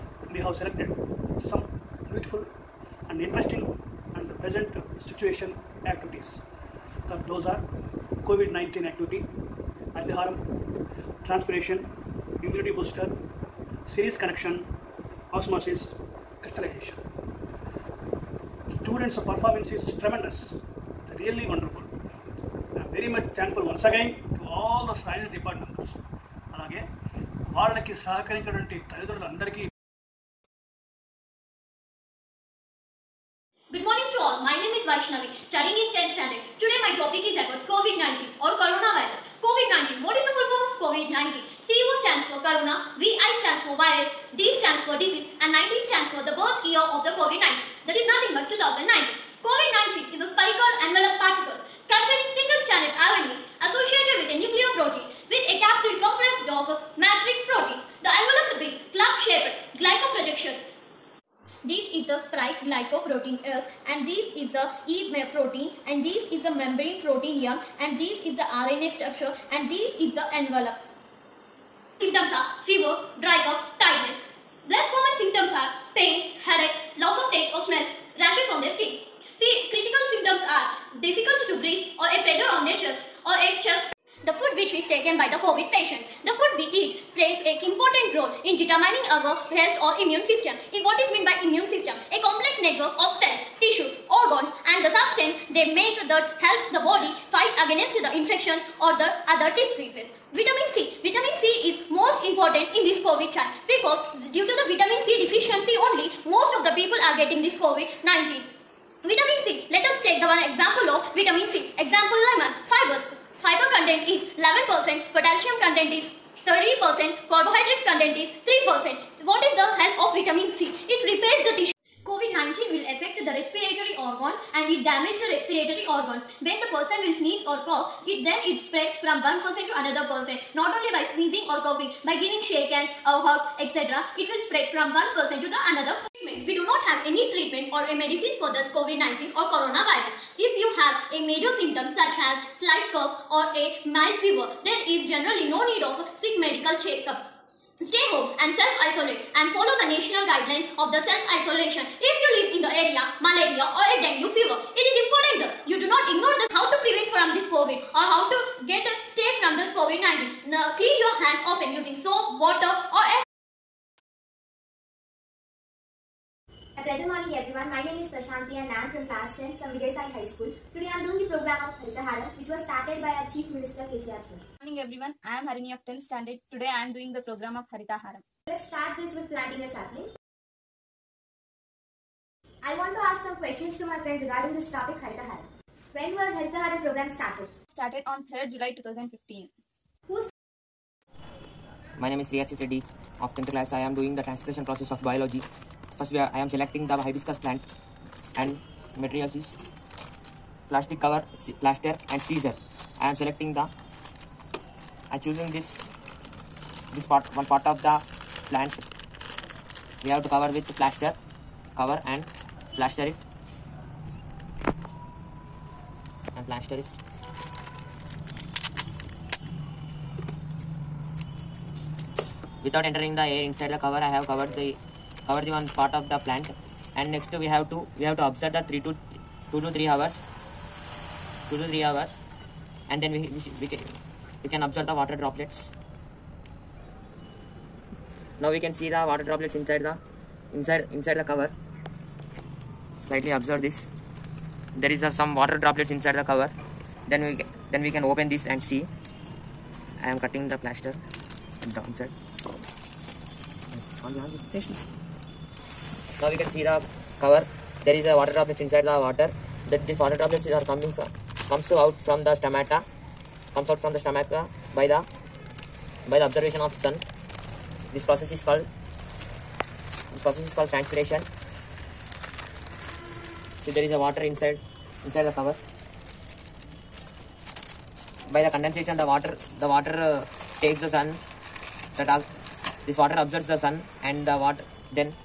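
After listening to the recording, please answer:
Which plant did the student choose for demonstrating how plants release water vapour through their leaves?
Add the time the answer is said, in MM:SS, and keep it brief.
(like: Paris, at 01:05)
Hibiscus, at 03:16.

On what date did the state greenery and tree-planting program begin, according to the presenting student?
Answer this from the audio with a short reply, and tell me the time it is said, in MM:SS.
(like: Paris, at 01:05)
3 July 2015, at 03:08.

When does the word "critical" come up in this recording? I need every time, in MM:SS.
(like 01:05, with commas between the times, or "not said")
01:19.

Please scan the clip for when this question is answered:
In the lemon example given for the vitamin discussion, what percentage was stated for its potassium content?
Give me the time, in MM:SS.
01:55.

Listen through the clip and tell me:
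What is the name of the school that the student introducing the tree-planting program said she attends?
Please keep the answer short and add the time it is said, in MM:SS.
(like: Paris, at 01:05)
Sai High School, at 02:49.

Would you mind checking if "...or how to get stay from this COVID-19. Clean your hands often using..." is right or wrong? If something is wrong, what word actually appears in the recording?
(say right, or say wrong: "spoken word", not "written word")
right.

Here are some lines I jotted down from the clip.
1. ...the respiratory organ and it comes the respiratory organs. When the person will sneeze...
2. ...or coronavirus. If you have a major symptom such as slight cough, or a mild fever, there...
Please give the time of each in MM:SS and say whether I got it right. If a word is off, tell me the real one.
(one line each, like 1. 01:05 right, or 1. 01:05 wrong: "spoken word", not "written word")
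1. 02:03 wrong: "damages", not "comes"
2. 02:19 right.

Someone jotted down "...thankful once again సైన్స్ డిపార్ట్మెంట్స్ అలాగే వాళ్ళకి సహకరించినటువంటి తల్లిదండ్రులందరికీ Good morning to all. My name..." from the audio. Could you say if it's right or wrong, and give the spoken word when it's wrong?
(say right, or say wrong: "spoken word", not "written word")
right.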